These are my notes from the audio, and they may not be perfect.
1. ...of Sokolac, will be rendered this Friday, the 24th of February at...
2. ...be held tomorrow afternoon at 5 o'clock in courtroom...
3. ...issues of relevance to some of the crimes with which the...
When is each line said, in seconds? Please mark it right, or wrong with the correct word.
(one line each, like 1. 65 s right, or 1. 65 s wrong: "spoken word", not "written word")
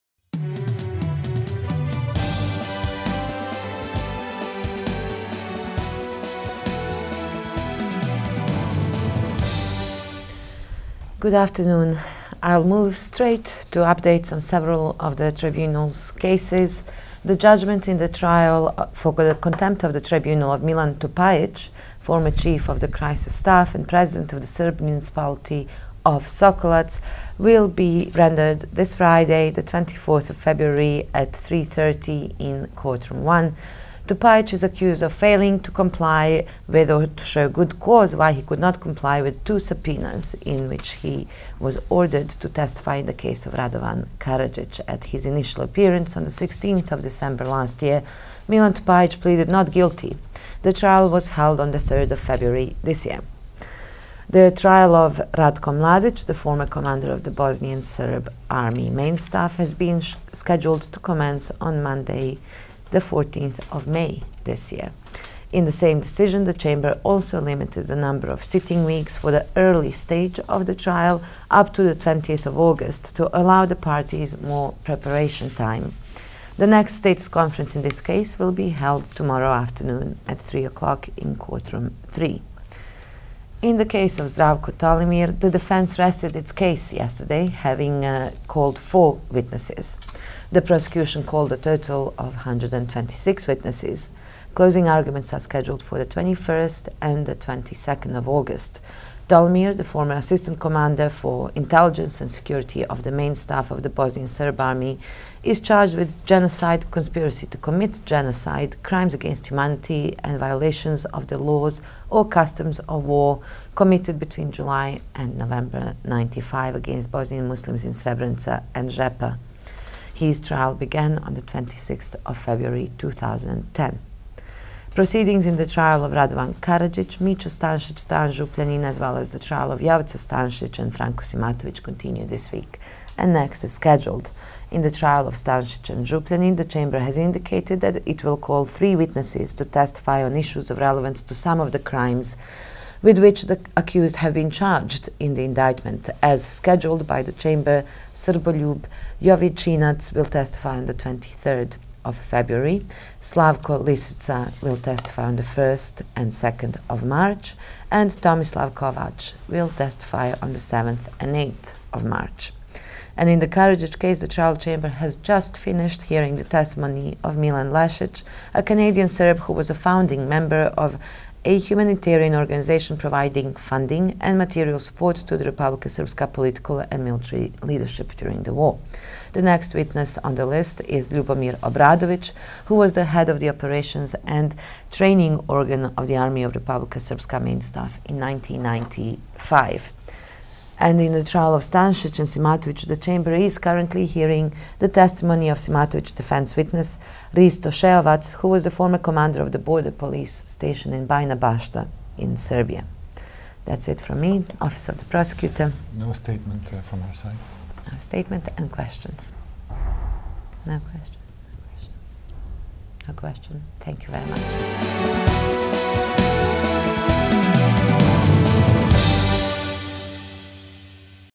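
1. 26 s right
2. 78 s wrong: "3", not "5"
3. 140 s right.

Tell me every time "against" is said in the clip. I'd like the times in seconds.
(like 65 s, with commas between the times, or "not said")
109 s, 116 s.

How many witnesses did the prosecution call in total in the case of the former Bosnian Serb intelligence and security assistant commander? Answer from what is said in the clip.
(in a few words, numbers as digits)
126.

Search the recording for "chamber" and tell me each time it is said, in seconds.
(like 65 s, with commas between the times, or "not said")
66 s, 136 s, 147 s, 164 s, 192 s.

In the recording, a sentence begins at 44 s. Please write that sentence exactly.
At his initial appearance on the 16th of December last year, Milan Tupajic pleaded not guilty.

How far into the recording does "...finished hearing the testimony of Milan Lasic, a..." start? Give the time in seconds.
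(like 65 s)
165 s.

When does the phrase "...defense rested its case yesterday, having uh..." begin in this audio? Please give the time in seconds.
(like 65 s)
85 s.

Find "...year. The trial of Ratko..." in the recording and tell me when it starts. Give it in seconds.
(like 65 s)
53 s.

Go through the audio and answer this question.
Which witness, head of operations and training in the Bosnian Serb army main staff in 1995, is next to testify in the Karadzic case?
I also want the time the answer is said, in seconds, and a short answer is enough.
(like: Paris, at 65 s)
Ljubomir Obradović, at 181 s.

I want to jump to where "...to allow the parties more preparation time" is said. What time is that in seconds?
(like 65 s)
73 s.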